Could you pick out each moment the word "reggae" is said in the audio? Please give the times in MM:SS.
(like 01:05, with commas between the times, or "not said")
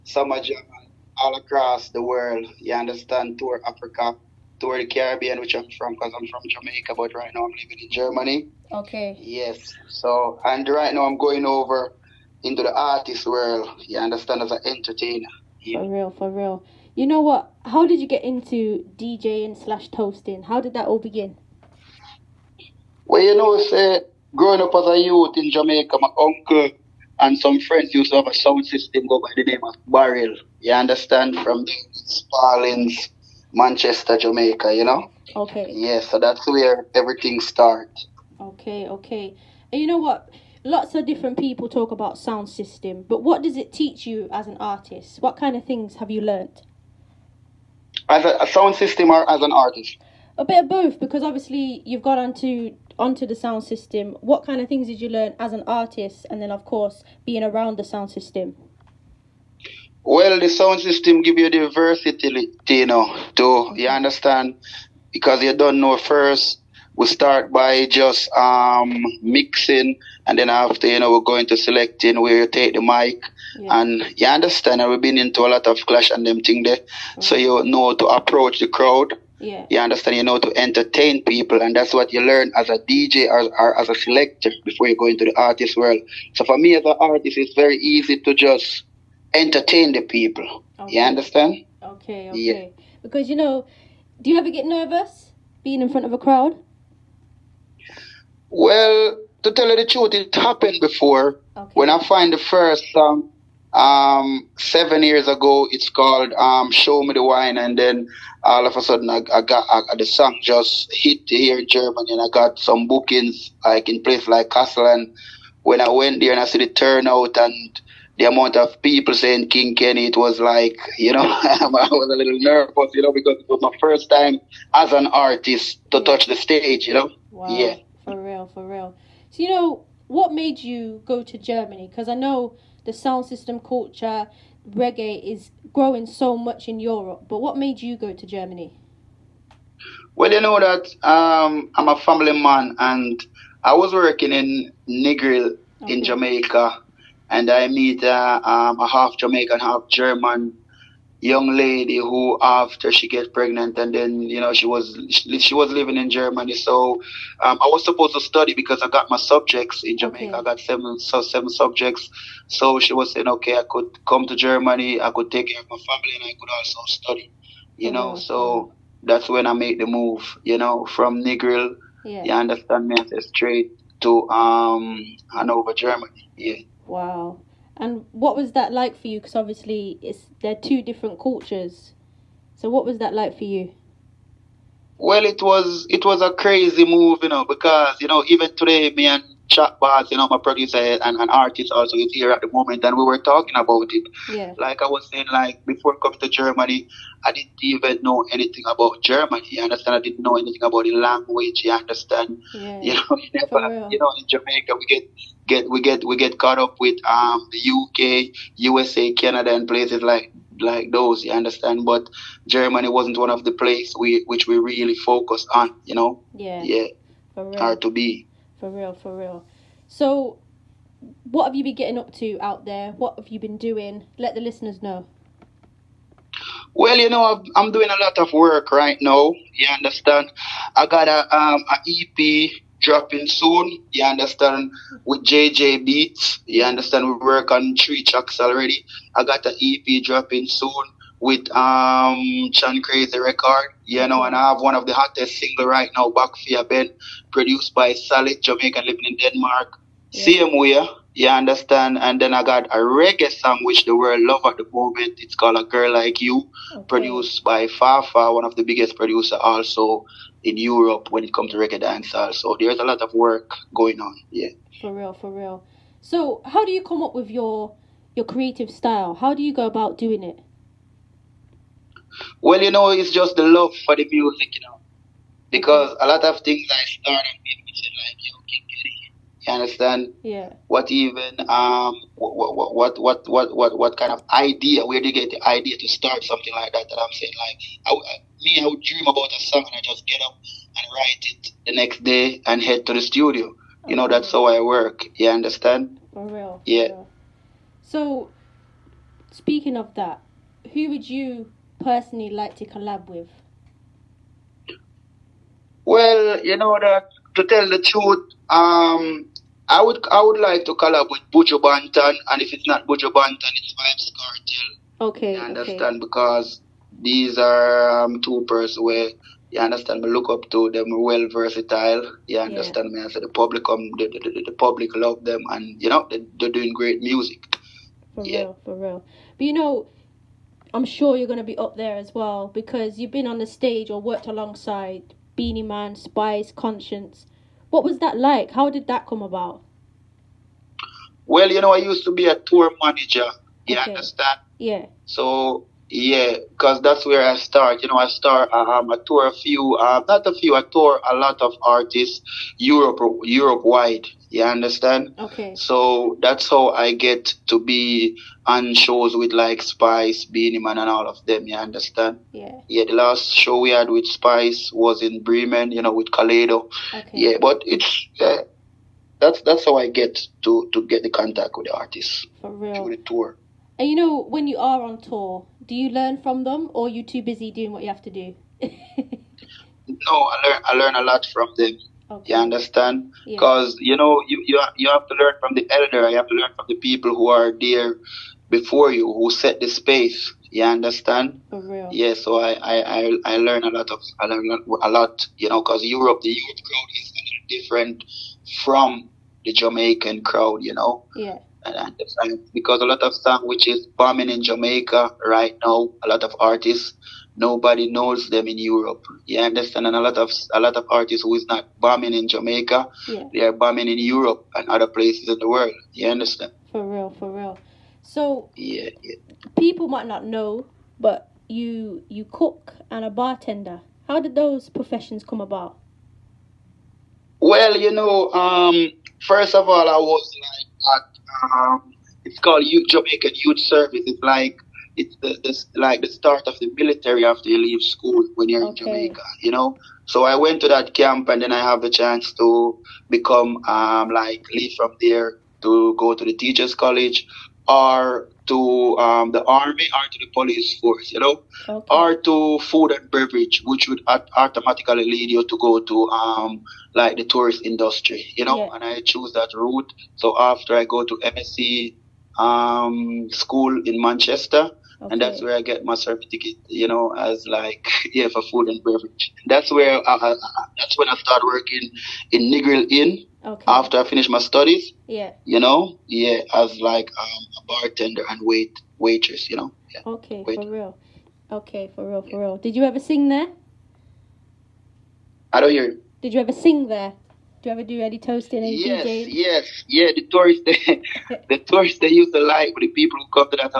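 02:14, 04:12, 04:21.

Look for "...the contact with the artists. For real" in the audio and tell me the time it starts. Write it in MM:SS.
06:11.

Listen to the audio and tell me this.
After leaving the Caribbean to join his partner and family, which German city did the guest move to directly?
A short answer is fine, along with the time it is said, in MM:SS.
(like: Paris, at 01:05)
Hanover, at 02:55.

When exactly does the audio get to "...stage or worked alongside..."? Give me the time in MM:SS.
05:33.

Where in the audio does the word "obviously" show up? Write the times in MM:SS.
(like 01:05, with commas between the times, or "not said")
00:51, 02:59.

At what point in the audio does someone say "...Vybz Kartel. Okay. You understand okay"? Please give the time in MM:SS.
05:13.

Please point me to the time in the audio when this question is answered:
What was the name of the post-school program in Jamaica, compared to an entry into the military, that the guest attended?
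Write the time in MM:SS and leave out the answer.
07:12.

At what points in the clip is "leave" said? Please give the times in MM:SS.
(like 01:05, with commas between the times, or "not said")
07:17, 07:24.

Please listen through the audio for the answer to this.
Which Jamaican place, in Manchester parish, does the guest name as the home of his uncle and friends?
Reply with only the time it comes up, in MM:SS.
00:31.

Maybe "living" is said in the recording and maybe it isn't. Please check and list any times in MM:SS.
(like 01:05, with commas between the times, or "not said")
00:07, 02:35, 04:08.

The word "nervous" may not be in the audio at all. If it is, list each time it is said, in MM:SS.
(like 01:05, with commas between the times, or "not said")
01:34, 02:02.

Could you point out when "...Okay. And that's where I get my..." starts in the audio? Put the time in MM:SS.
07:45.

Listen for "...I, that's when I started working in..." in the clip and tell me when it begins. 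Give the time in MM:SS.
07:50.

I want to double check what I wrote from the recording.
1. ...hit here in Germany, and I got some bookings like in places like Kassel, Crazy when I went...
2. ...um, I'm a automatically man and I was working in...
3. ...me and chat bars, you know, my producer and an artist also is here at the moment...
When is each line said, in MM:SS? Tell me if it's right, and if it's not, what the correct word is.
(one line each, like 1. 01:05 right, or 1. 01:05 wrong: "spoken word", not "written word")
1. 01:50 wrong: "And", not "Crazy"
2. 02:21 wrong: "family", not "automatically"
3. 03:08 right.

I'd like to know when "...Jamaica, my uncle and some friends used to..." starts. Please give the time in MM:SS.
00:25.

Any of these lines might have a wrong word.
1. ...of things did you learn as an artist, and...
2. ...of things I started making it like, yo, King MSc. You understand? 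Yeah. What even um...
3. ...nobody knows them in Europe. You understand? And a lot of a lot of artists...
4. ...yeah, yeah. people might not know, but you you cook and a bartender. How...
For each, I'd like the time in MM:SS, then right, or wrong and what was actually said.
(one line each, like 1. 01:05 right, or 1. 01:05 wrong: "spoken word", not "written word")
1. 00:54 right
2. 04:36 wrong: "Kitty", not "MSc"
3. 06:47 right
4. 06:58 right.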